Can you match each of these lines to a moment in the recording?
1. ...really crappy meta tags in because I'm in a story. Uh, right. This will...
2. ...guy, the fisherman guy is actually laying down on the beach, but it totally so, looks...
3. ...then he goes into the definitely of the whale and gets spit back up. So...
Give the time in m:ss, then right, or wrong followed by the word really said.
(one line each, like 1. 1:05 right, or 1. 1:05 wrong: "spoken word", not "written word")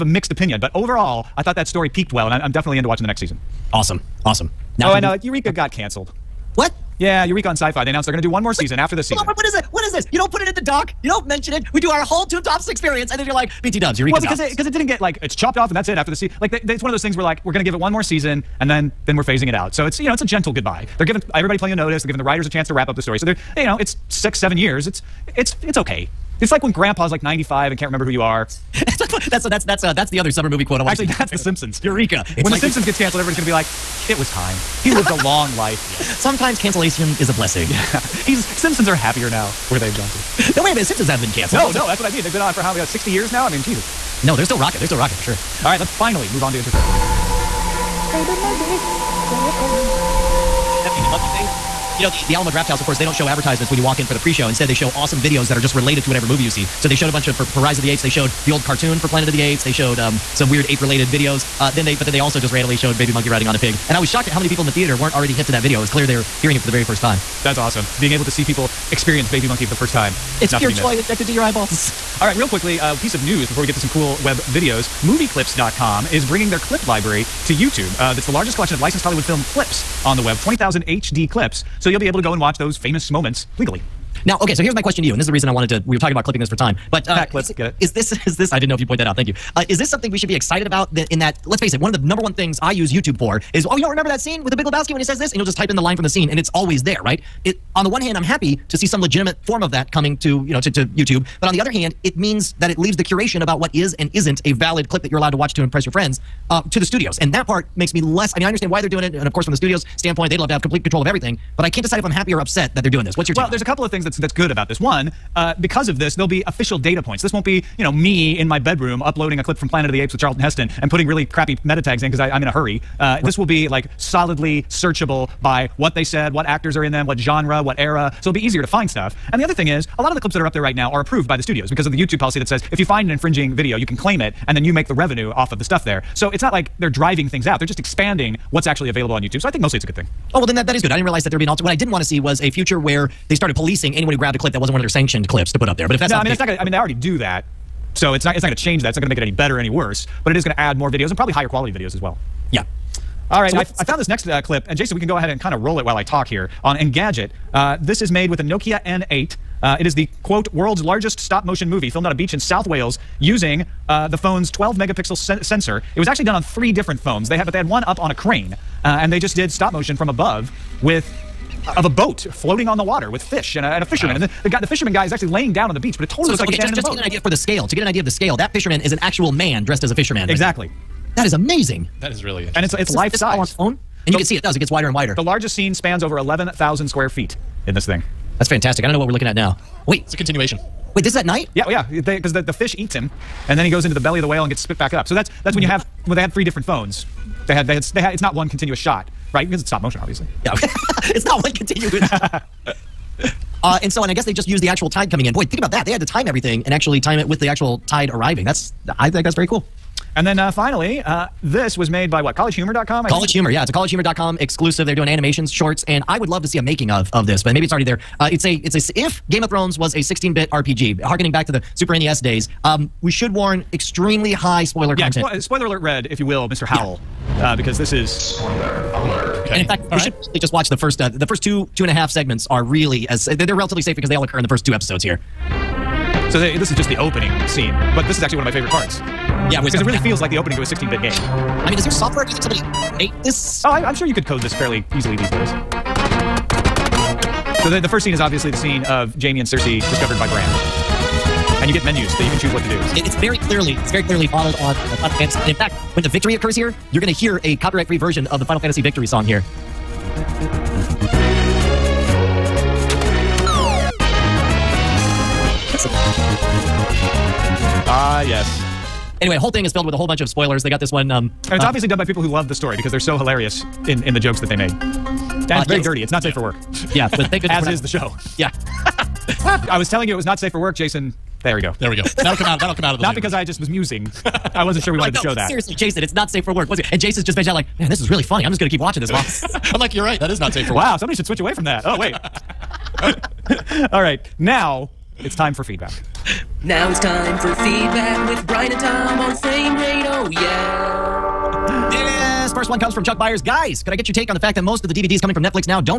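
1. 2:01 wrong: "hurry", not "story"
2. 2:54 right
3. 3:13 wrong: "belly", not "definitely".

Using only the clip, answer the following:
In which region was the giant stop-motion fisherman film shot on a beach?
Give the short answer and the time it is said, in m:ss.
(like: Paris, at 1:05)
South Wales, at 2:42.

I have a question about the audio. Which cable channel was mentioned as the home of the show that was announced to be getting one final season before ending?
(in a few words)
Syfy.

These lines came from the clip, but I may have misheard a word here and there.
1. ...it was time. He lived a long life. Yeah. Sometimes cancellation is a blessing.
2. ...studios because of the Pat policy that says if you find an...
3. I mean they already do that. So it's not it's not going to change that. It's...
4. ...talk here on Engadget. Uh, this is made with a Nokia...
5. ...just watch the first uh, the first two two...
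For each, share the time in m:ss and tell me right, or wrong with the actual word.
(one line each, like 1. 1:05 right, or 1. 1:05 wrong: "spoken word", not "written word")
1. 0:34 right
2. 2:11 wrong: "YouTube", not "Pat"
3. 2:26 right
4. 2:36 right
5. 3:50 right.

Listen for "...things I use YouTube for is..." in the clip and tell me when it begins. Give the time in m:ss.
1:32.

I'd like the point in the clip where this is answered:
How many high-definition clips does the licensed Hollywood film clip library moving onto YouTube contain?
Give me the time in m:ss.
1:20.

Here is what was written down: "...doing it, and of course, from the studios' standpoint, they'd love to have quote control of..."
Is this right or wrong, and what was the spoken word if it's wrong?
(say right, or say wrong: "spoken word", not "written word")
wrong: "complete", not "quote".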